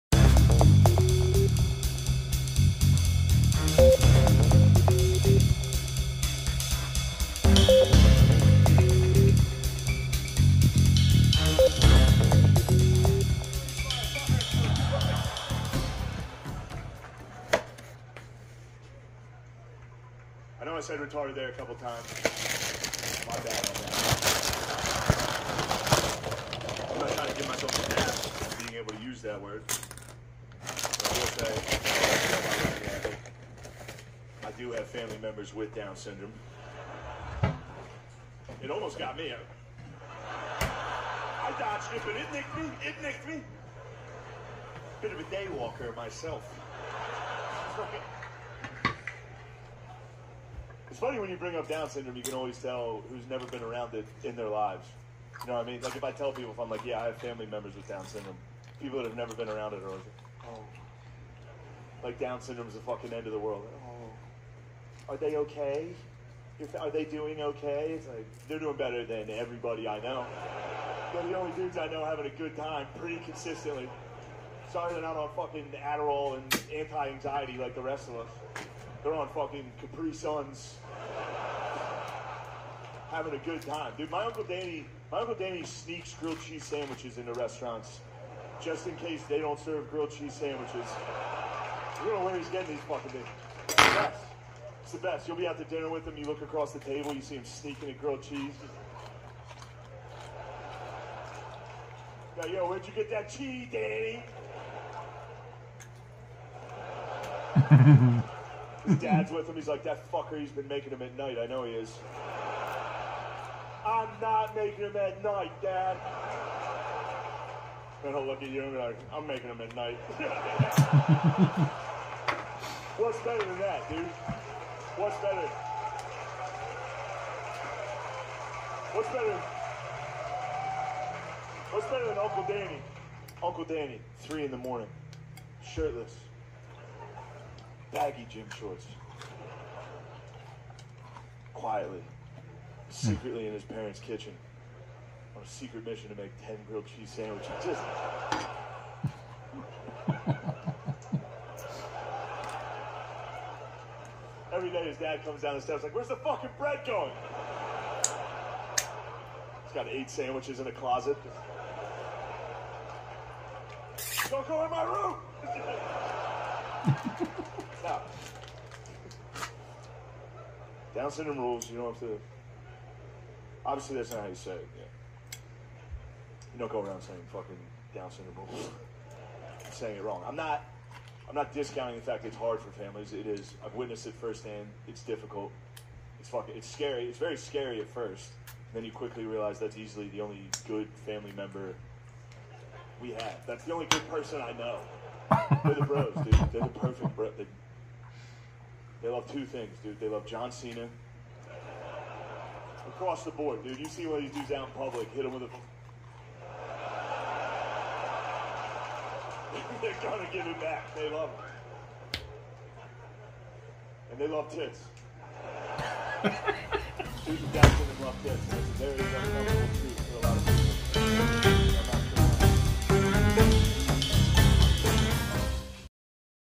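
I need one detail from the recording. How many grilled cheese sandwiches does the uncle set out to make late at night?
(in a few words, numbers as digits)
10.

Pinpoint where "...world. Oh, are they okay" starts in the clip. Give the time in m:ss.
1:03.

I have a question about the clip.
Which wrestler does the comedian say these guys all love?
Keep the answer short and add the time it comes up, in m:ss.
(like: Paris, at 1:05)
John Cena, at 3:20.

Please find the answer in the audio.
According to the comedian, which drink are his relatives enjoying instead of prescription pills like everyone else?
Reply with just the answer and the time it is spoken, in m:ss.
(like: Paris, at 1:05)
Capri Suns, at 1:19.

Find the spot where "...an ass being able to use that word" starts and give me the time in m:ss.
0:27.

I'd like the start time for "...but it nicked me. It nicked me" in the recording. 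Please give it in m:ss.
0:42.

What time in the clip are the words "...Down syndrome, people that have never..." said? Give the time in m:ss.
0:57.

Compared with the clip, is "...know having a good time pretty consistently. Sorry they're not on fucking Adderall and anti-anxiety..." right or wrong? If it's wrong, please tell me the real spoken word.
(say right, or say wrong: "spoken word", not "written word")
right.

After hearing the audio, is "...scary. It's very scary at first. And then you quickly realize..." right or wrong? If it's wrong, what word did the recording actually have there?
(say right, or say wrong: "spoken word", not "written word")
right.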